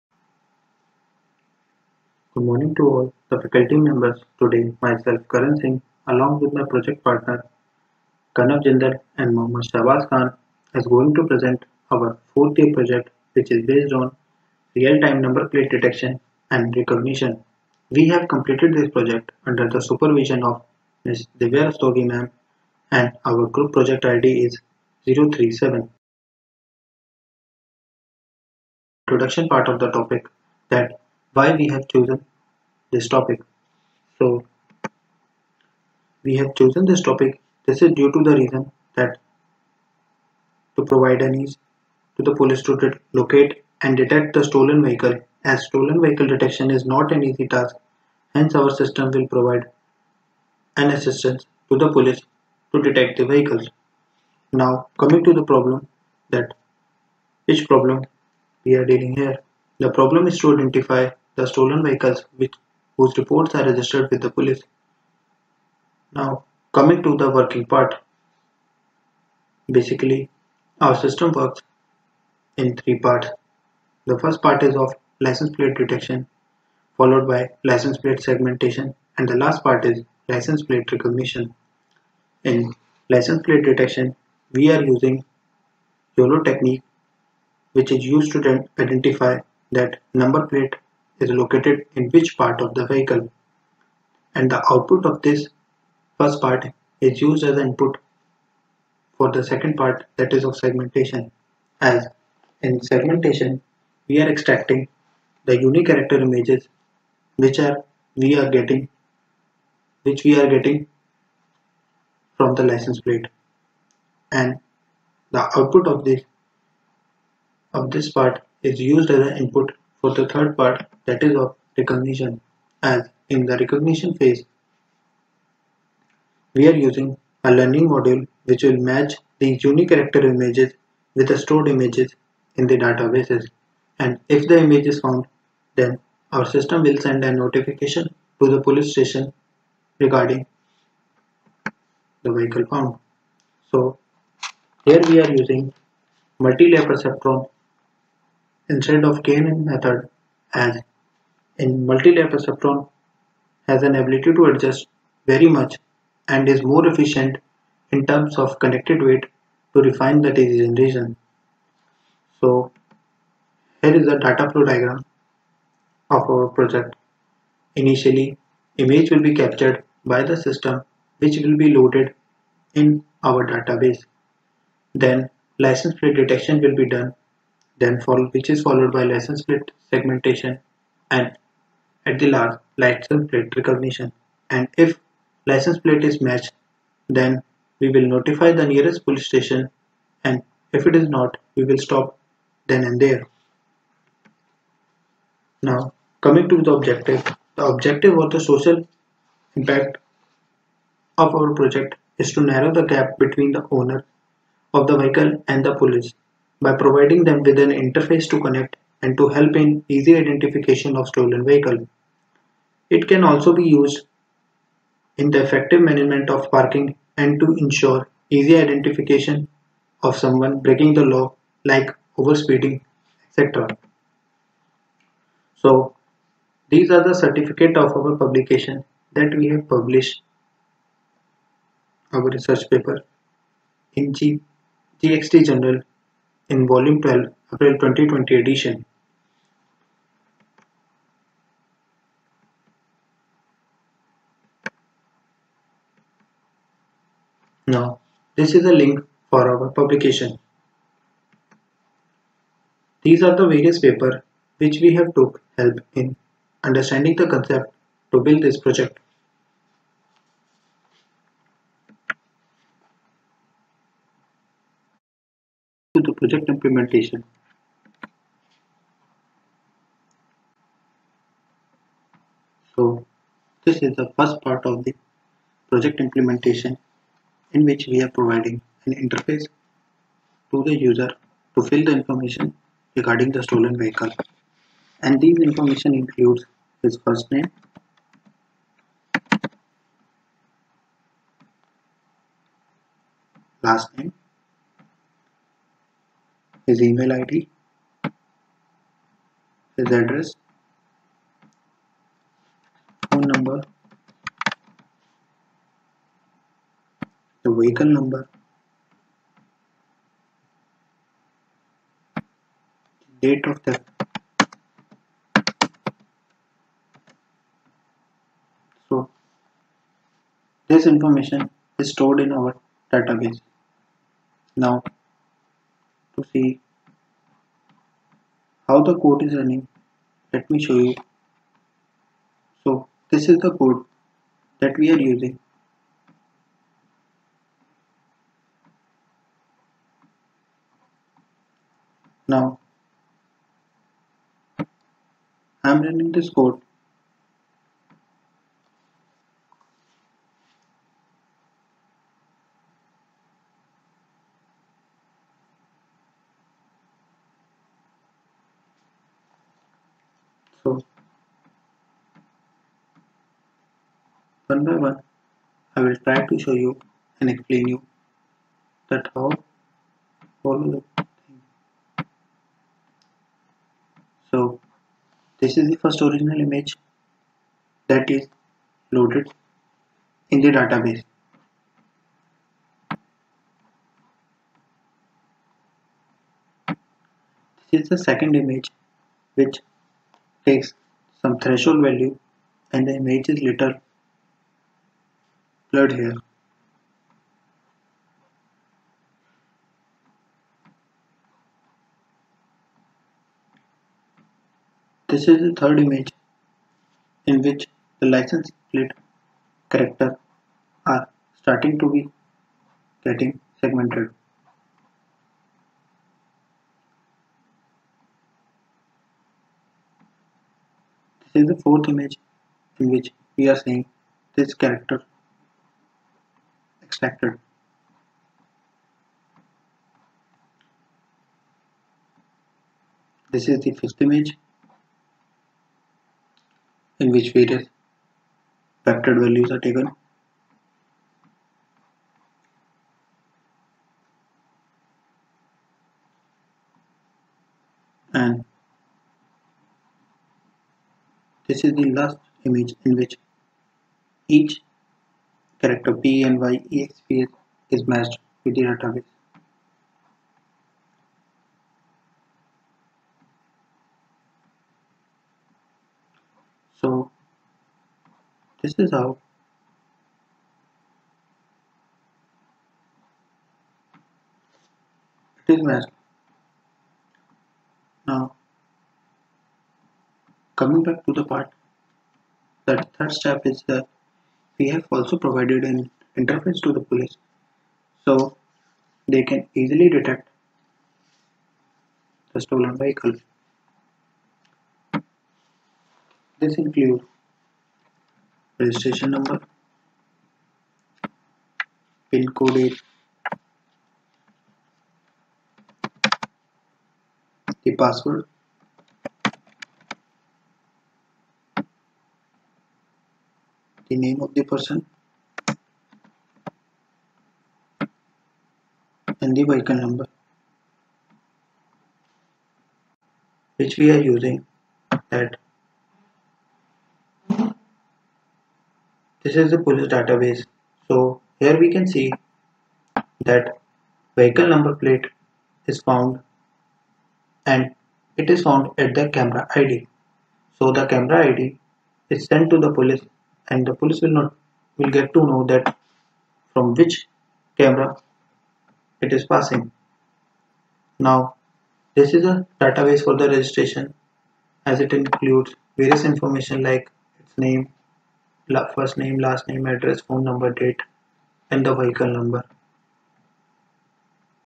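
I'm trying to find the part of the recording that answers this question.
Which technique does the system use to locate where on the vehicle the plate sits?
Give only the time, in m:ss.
1:26.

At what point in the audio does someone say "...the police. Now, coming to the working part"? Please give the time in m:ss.
1:04.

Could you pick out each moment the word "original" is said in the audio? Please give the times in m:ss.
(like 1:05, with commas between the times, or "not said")
6:16.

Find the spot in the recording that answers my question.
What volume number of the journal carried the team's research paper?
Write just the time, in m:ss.
3:56.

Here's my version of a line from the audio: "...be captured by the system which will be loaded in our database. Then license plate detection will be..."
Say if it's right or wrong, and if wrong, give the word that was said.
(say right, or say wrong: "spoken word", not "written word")
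right.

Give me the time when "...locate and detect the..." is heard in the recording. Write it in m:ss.
0:43.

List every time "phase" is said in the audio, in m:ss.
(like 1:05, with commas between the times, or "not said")
2:04.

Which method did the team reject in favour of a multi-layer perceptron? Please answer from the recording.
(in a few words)
KNN.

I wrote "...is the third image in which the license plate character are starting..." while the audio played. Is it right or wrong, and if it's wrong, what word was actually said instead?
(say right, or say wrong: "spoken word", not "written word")
right.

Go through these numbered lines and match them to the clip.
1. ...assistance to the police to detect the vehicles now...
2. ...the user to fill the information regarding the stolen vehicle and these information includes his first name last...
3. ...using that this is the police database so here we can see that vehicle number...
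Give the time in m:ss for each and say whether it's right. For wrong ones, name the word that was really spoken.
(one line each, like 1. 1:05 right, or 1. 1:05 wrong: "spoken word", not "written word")
1. 0:50 right
2. 4:40 right
3. 8:44 right.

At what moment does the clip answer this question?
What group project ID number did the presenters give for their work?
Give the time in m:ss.
0:25.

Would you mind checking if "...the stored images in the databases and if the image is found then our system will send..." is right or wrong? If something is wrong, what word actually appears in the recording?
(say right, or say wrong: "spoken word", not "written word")
right.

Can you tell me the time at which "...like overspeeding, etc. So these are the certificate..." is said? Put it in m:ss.
3:41.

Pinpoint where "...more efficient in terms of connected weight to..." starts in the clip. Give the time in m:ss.
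2:36.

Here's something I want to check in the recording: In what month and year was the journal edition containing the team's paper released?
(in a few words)
April 2020.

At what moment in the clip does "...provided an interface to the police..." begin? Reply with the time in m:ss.
8:05.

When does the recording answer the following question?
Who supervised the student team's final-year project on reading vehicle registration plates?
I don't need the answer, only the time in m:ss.
0:21.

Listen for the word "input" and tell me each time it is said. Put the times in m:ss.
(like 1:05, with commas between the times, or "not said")
1:37, 1:59.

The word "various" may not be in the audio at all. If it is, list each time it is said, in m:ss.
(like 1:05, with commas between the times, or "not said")
4:13, 7:17, 9:15.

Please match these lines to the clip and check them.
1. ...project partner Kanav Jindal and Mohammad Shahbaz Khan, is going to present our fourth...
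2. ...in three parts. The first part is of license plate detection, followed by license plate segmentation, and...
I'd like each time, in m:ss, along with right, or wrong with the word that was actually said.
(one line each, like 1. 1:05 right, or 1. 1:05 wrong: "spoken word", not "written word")
1. 0:06 right
2. 1:12 right.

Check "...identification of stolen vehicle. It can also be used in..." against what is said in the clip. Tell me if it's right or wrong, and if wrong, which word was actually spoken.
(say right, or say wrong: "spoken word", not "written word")
right.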